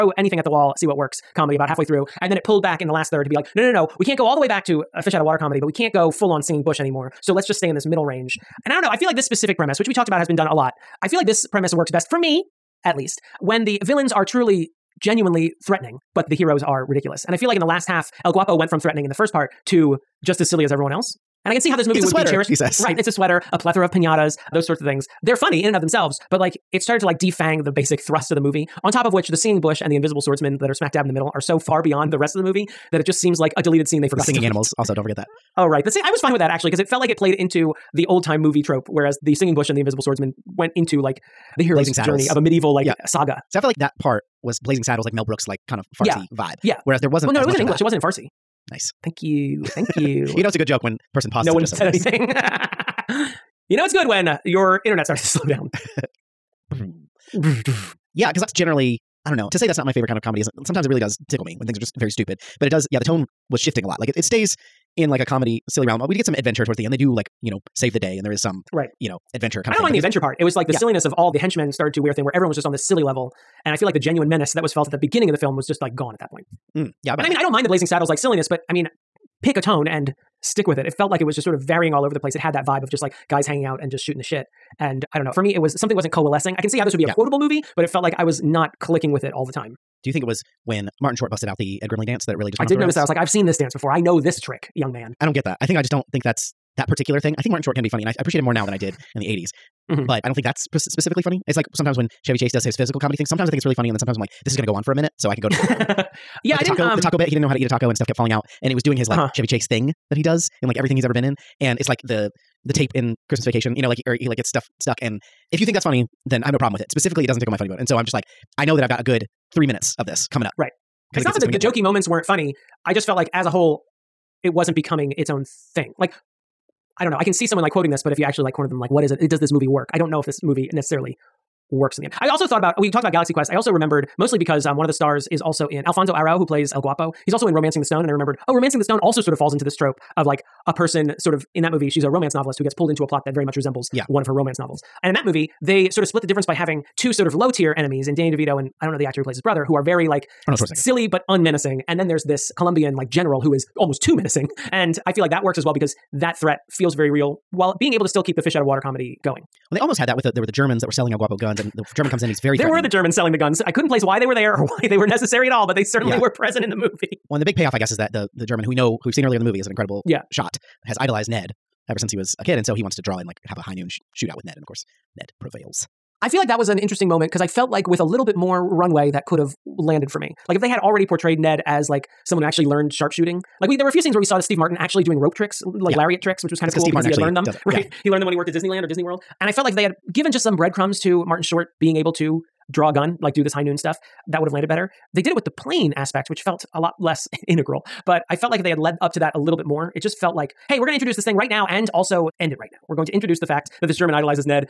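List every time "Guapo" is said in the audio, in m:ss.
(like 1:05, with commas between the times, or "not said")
0:18, 2:16, 2:41.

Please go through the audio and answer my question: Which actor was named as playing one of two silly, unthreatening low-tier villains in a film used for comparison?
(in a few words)
Danny DeVito.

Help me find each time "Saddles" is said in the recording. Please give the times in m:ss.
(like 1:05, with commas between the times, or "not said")
0:44, 1:17.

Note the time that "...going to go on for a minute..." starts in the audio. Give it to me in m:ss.
1:44.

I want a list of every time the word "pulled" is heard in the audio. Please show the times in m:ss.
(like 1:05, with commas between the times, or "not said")
0:02, 2:22.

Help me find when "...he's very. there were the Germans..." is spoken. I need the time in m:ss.
2:42.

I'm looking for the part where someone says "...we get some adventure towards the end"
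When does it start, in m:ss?
1:06.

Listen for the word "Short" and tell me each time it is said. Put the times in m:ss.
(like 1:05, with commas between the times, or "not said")
1:31, 1:37, 3:11.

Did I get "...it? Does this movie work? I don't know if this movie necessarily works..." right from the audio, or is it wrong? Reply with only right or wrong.
right.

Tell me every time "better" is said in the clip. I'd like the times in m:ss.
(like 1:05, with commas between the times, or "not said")
3:14.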